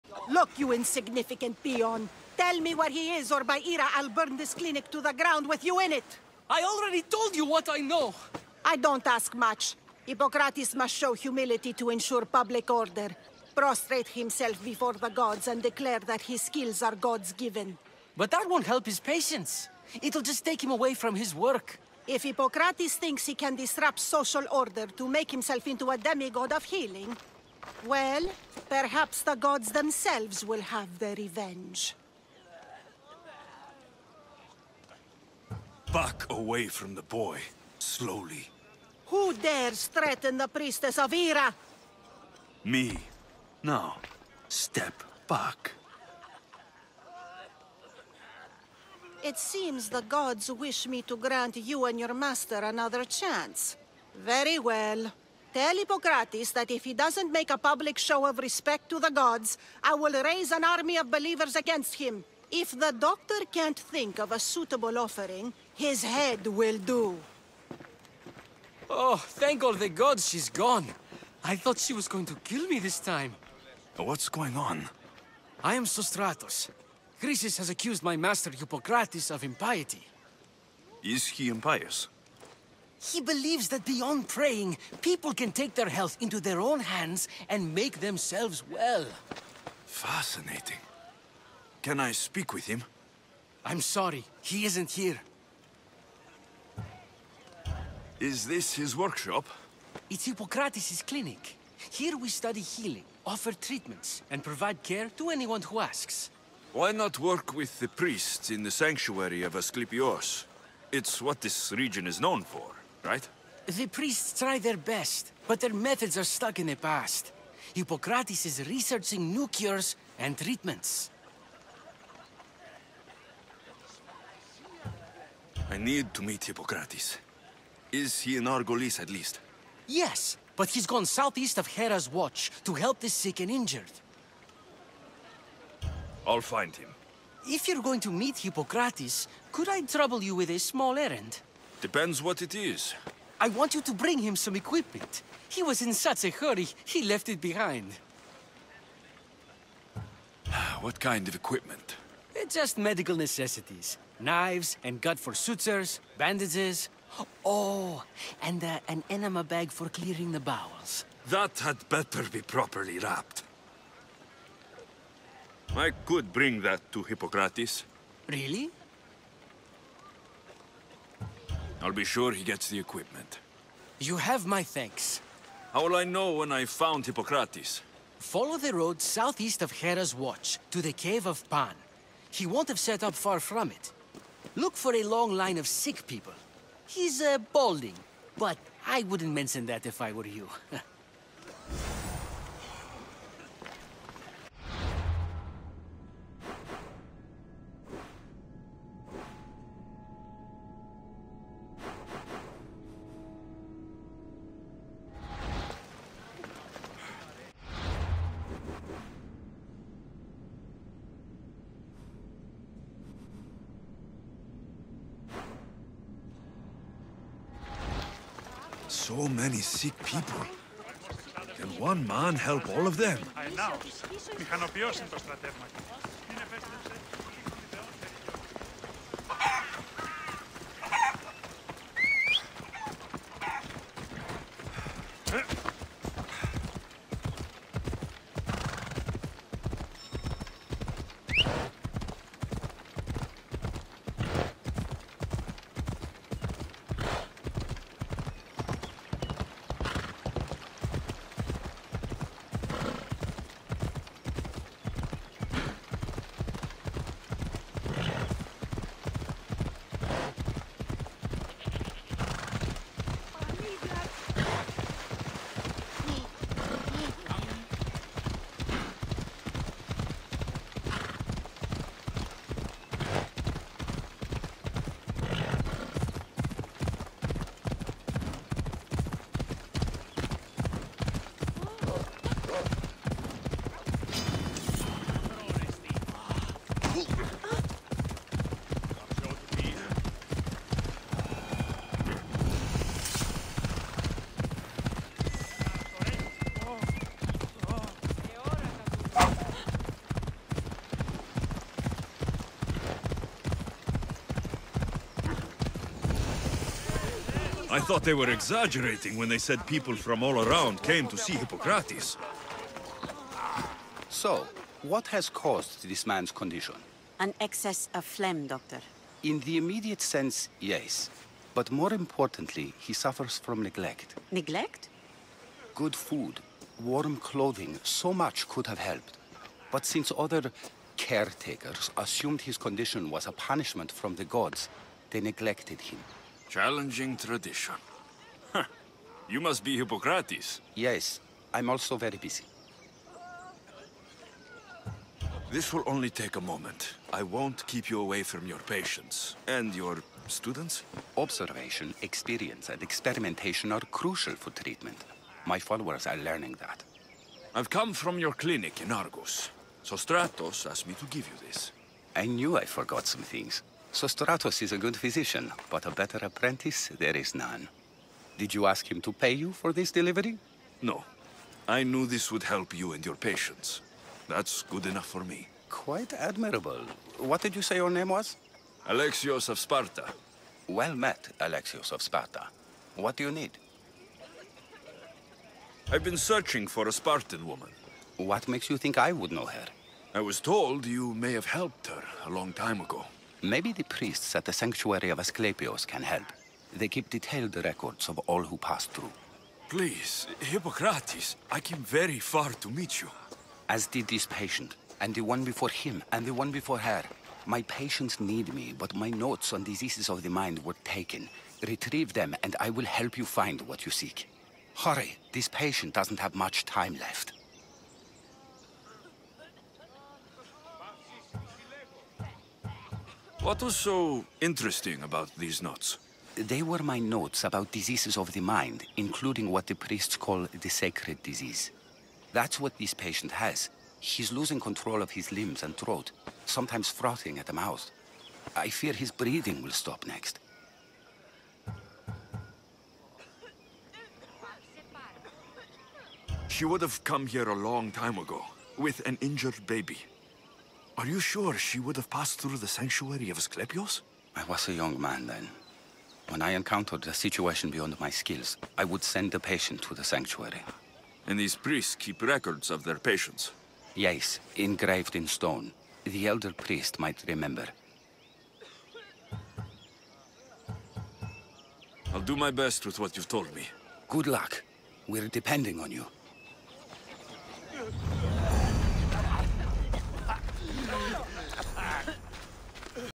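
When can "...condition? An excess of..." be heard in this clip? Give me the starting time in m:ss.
5:16.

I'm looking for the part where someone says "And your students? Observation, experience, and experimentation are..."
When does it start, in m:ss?
5:49.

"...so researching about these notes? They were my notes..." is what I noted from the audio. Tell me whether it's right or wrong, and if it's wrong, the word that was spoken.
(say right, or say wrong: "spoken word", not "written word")
wrong: "interesting", not "researching".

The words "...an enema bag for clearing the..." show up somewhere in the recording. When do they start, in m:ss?
2:38.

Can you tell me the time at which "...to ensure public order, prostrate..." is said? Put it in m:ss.
0:11.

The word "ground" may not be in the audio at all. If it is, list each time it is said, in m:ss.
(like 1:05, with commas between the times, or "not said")
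0:05.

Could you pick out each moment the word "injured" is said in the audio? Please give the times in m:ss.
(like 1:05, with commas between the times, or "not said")
2:13, 7:29.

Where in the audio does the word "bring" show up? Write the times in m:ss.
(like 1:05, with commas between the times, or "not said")
2:23, 2:46.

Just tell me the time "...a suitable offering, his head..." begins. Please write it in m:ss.
1:04.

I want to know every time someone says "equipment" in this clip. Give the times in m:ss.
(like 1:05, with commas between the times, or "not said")
2:24, 2:31, 2:52.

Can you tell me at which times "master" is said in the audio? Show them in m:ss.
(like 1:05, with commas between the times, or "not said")
0:52, 1:18.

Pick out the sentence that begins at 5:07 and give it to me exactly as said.
I thought they were exaggerating when they said people from all around came to see Hippocrates.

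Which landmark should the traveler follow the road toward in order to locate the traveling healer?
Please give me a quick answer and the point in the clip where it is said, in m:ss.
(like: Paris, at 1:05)
cave of Pan, at 3:00.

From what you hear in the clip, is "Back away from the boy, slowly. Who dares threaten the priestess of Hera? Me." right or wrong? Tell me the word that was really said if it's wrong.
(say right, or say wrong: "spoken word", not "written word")
right.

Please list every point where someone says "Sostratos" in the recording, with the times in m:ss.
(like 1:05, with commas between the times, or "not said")
1:15, 5:59, 6:03.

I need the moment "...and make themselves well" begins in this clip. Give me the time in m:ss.
1:27.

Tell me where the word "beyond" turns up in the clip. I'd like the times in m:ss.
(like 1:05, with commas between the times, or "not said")
1:23, 7:37.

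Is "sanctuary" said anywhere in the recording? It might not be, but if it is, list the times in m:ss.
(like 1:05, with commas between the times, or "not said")
1:48, 6:34, 7:32, 7:40.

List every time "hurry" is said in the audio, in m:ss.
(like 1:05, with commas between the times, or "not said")
2:26, 6:54.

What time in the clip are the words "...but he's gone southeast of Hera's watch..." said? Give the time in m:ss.
2:10.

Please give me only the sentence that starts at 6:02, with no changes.
I knew I forgot some things.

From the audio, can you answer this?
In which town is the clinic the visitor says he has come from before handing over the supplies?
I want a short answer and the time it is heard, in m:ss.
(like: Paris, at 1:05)
Argos, at 5:58.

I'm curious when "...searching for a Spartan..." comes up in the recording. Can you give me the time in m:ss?
6:26.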